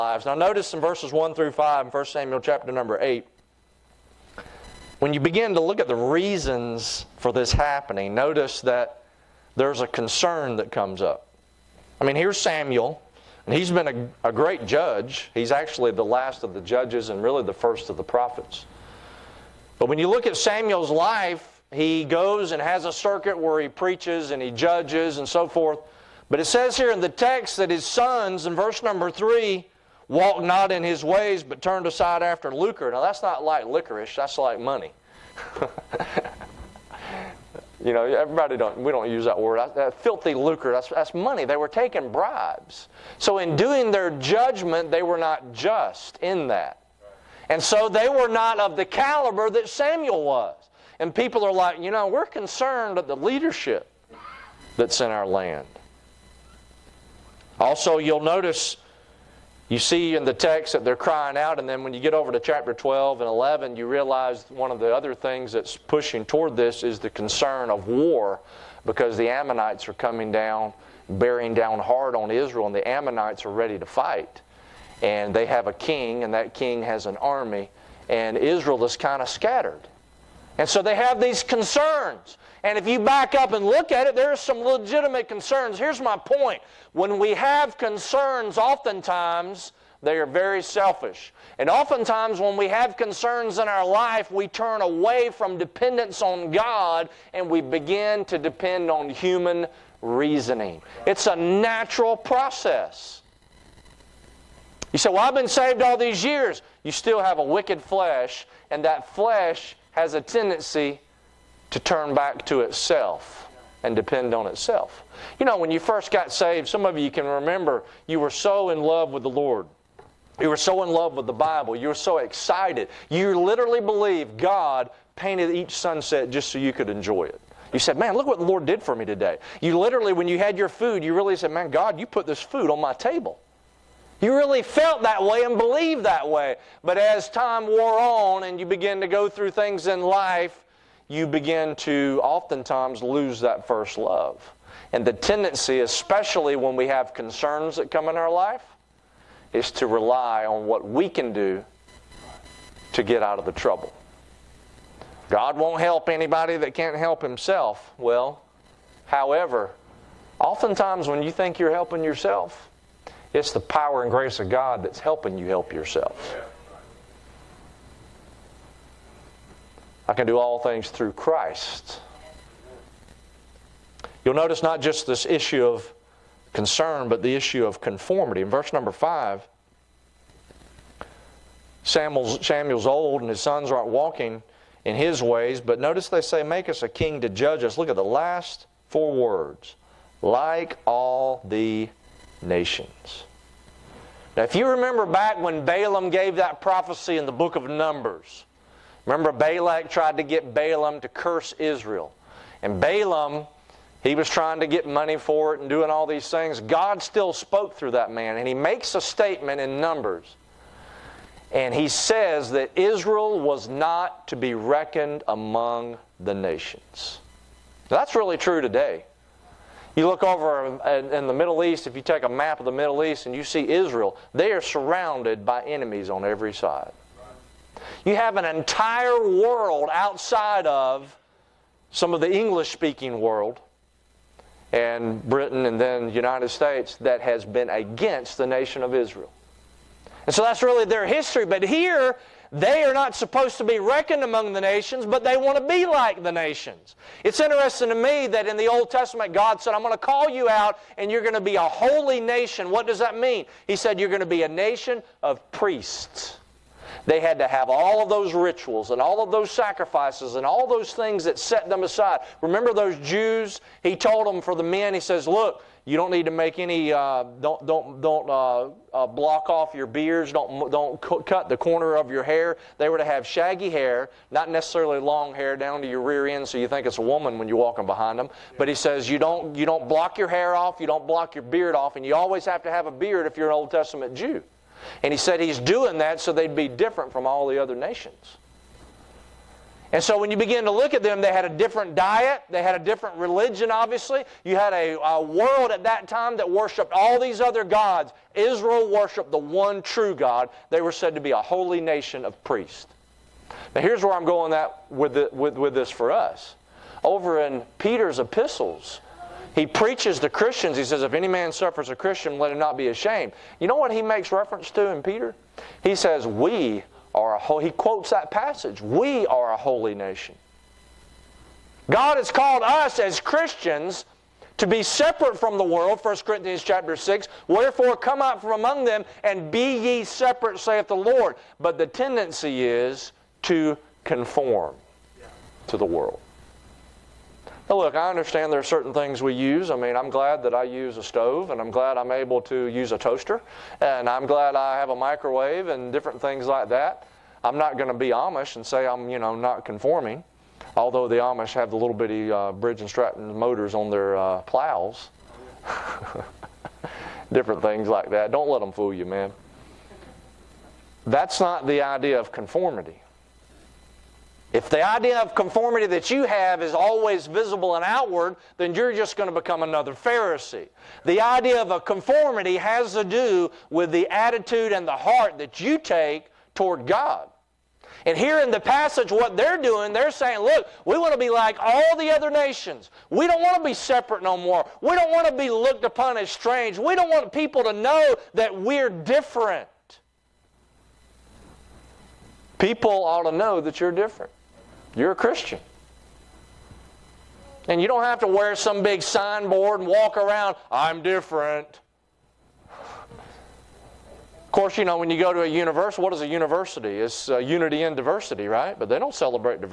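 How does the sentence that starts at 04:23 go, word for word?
He told them for the men, he says, Look, you don't need to make any.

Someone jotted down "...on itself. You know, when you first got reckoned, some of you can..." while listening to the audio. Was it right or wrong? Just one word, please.
wrong.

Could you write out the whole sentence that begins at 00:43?
So, in doing their judgment, they were not just in that.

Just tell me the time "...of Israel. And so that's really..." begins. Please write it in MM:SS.
03:58.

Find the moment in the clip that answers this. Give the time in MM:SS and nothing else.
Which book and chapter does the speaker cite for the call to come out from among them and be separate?
05:26.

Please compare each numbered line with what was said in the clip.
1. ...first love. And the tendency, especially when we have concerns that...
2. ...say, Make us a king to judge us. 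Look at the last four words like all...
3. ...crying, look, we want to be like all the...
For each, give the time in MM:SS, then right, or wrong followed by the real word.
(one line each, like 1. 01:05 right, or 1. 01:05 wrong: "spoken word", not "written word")
1. 02:23 right
2. 03:06 right
3. 06:20 wrong: "saying", not "crying".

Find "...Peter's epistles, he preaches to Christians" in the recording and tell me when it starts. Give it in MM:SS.
05:07.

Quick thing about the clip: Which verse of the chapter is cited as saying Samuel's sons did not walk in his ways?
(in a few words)
Verse 3.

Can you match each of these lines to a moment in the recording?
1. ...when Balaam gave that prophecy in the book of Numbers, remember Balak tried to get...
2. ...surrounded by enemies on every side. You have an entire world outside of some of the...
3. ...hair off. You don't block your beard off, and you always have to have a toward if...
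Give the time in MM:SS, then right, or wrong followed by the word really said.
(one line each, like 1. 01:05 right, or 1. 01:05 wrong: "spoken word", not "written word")
1. 03:15 right
2. 03:44 right
3. 04:40 wrong: "beard", not "toward".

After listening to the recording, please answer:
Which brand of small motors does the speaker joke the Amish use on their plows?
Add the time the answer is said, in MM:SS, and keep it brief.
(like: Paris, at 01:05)
Briggs and Stratton, at 05:52.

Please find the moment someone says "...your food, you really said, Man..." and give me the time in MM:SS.
02:10.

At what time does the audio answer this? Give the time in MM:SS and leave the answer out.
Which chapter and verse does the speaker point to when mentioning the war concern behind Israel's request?
01:02.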